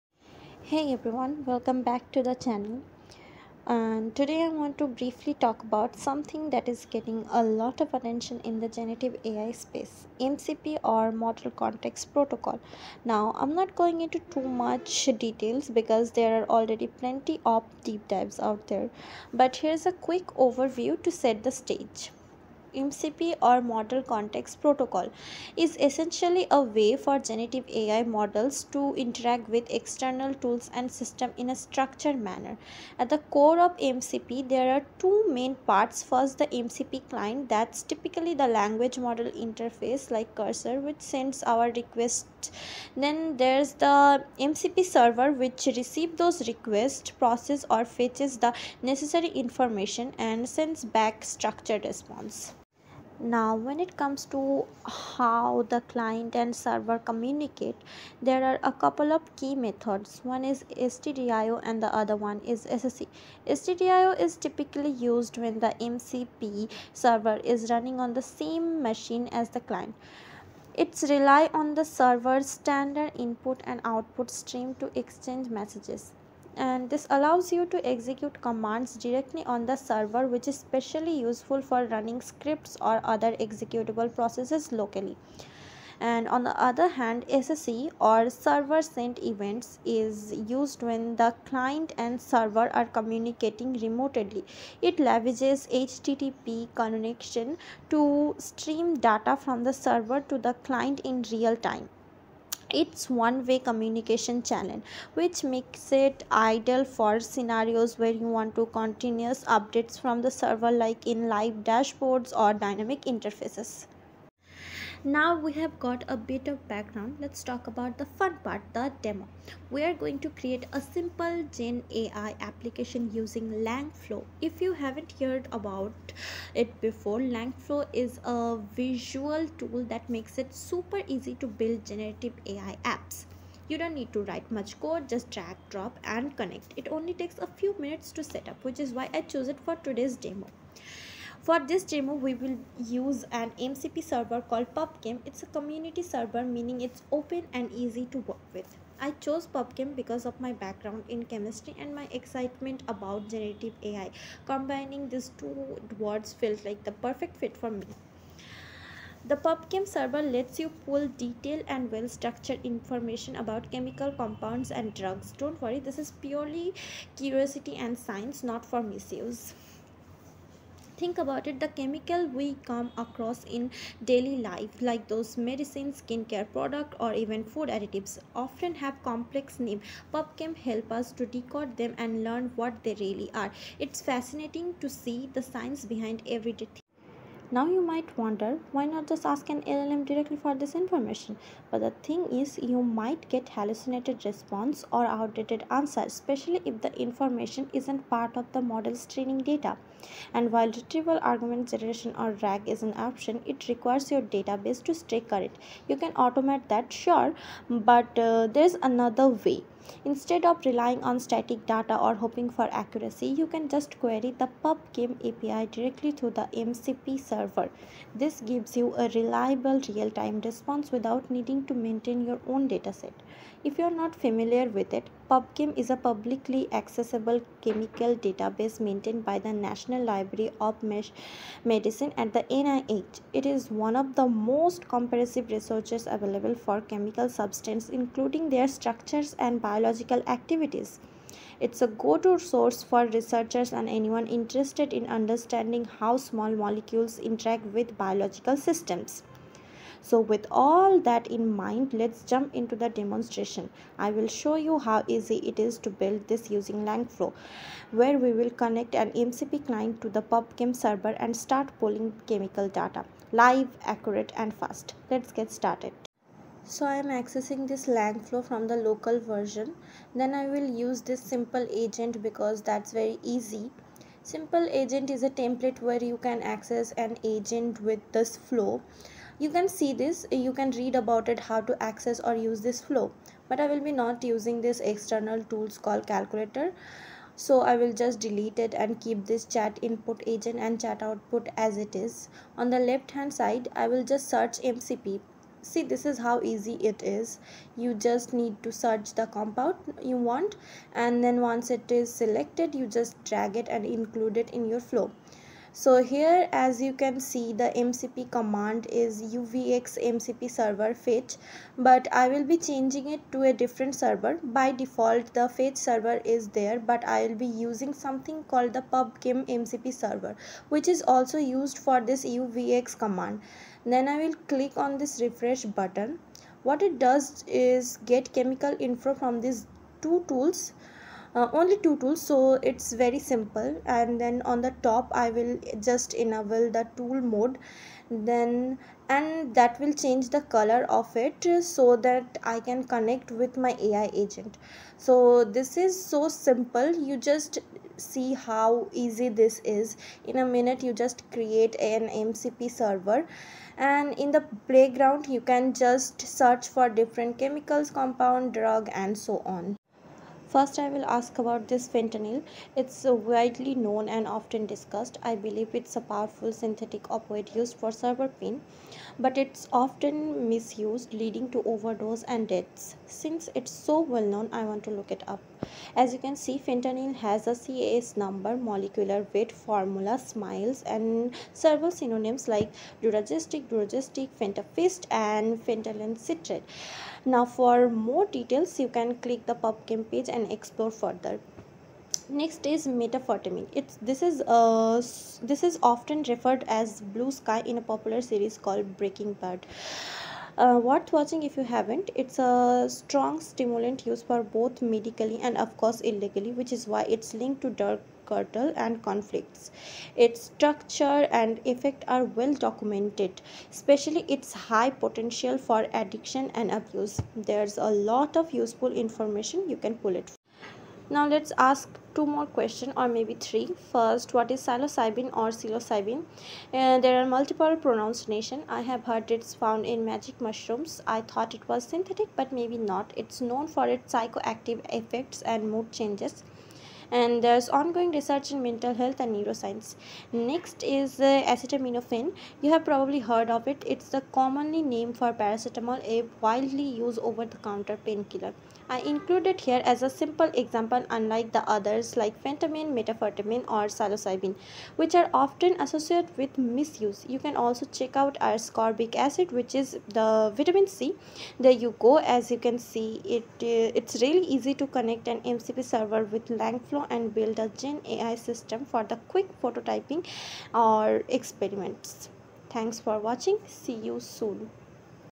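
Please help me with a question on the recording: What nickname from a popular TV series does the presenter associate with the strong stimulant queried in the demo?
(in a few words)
blue sky.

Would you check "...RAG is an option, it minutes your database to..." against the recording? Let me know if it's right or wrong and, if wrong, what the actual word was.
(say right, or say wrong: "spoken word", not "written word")
wrong: "requires", not "minutes".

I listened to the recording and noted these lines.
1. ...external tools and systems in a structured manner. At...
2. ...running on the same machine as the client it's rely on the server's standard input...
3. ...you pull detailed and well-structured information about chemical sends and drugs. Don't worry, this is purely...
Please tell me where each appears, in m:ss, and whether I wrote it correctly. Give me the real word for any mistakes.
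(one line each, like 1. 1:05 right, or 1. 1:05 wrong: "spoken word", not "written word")
1. 0:29 right
2. 1:07 right
3. 2:40 wrong: "compounds", not "sends".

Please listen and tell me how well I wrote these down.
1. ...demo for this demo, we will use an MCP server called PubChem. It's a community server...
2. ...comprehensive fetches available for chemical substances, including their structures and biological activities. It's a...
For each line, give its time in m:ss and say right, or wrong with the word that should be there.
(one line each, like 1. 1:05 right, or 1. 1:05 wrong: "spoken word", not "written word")
1. 2:20 right
2. 3:54 wrong: "researches", not "fetches".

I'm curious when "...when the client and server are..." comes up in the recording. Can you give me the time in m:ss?
1:30.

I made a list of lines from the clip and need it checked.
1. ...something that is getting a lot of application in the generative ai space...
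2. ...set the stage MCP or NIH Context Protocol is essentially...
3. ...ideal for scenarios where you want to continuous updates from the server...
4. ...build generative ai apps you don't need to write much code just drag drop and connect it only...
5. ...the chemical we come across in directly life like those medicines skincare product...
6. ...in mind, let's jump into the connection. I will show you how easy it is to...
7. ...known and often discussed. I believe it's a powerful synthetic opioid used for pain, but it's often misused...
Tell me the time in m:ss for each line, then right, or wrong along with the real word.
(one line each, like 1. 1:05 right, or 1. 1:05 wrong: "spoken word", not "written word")
1. 0:06 wrong: "attention", not "application"
2. 0:21 wrong: "Model", not "NIH"
3. 1:46 right
4. 2:11 right
5. 2:51 wrong: "daily", not "directly"
6. 4:11 wrong: "demonstration", not "connection"
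7. 6:03 right.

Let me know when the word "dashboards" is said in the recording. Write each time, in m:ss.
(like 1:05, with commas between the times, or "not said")
1:51.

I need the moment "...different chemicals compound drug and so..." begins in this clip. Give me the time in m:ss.
5:56.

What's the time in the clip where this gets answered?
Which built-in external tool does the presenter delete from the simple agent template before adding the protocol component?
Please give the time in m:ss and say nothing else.
4:46.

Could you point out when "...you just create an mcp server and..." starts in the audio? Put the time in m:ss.
5:50.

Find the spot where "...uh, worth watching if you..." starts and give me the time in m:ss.
6:40.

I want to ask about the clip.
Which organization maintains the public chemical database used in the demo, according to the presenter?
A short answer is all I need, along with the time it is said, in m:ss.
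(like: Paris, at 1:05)
National Library of Medicine, at 3:49.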